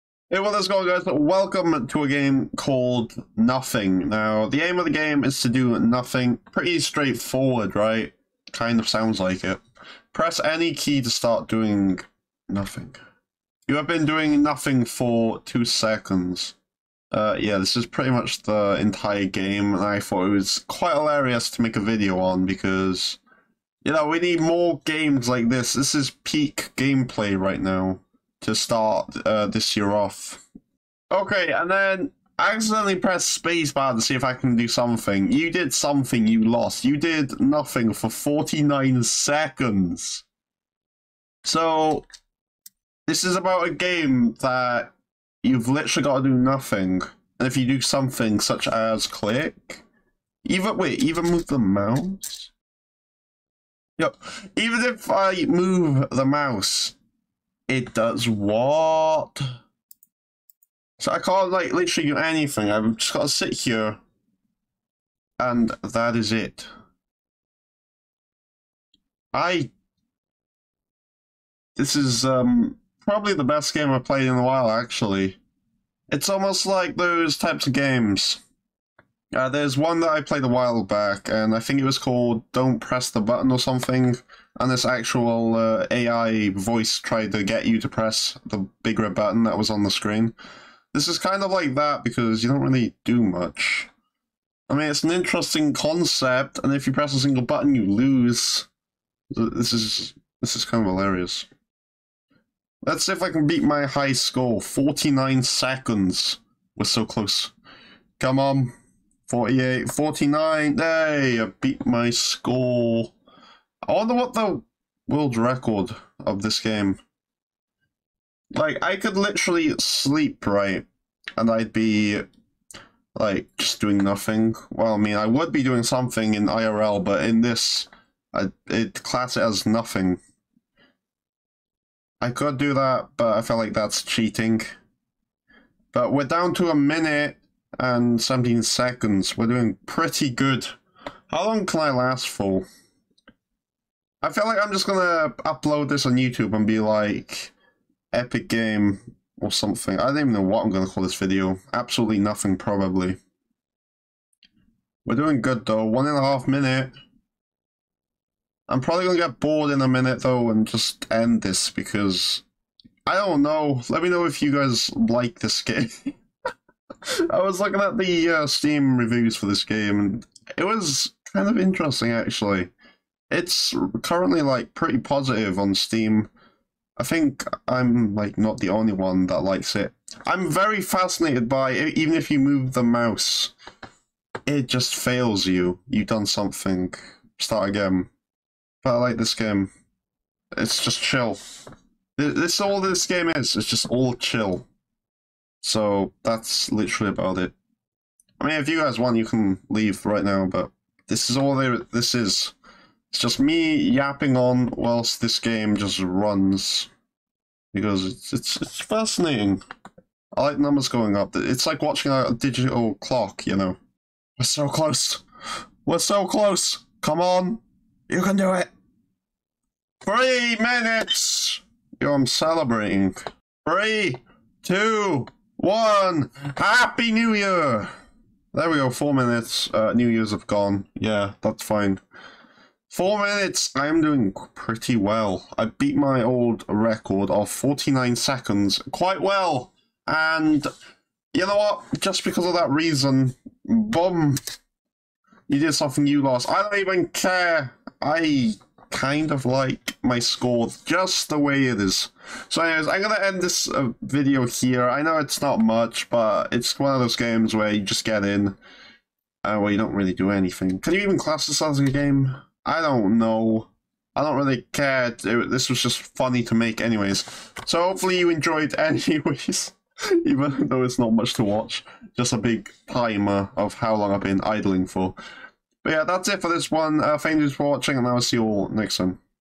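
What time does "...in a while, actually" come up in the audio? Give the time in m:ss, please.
1:14.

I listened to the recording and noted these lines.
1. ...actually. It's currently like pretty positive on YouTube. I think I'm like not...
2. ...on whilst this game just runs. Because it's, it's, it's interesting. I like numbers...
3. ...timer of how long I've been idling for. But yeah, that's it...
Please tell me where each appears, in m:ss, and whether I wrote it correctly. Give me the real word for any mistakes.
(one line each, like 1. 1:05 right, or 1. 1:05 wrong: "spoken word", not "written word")
1. 2:52 wrong: "Steam", not "YouTube"
2. 3:24 wrong: "fascinating", not "interesting"
3. 4:32 right.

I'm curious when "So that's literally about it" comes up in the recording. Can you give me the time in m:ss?
3:15.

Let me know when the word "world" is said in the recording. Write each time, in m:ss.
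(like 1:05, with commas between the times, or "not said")
1:55.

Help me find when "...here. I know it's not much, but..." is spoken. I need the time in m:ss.
4:14.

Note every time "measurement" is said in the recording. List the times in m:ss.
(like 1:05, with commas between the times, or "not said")
not said.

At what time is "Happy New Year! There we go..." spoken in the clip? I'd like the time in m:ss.
3:46.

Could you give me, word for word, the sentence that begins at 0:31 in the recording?
Okay, and then I accidentally pressed spacebar to see if I can do something.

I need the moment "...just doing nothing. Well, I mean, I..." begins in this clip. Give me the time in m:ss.
2:03.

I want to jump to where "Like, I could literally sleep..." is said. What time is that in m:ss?
1:58.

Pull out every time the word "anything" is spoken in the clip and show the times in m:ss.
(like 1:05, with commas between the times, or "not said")
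1:02, 4:20.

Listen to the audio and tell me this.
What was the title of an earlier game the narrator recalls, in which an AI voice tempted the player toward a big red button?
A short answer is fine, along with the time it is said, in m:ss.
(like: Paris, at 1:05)
Don't Press the Button, at 1:22.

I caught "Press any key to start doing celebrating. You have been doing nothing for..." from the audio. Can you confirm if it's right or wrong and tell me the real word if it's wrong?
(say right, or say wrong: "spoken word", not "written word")
wrong: "nothing", not "celebrating".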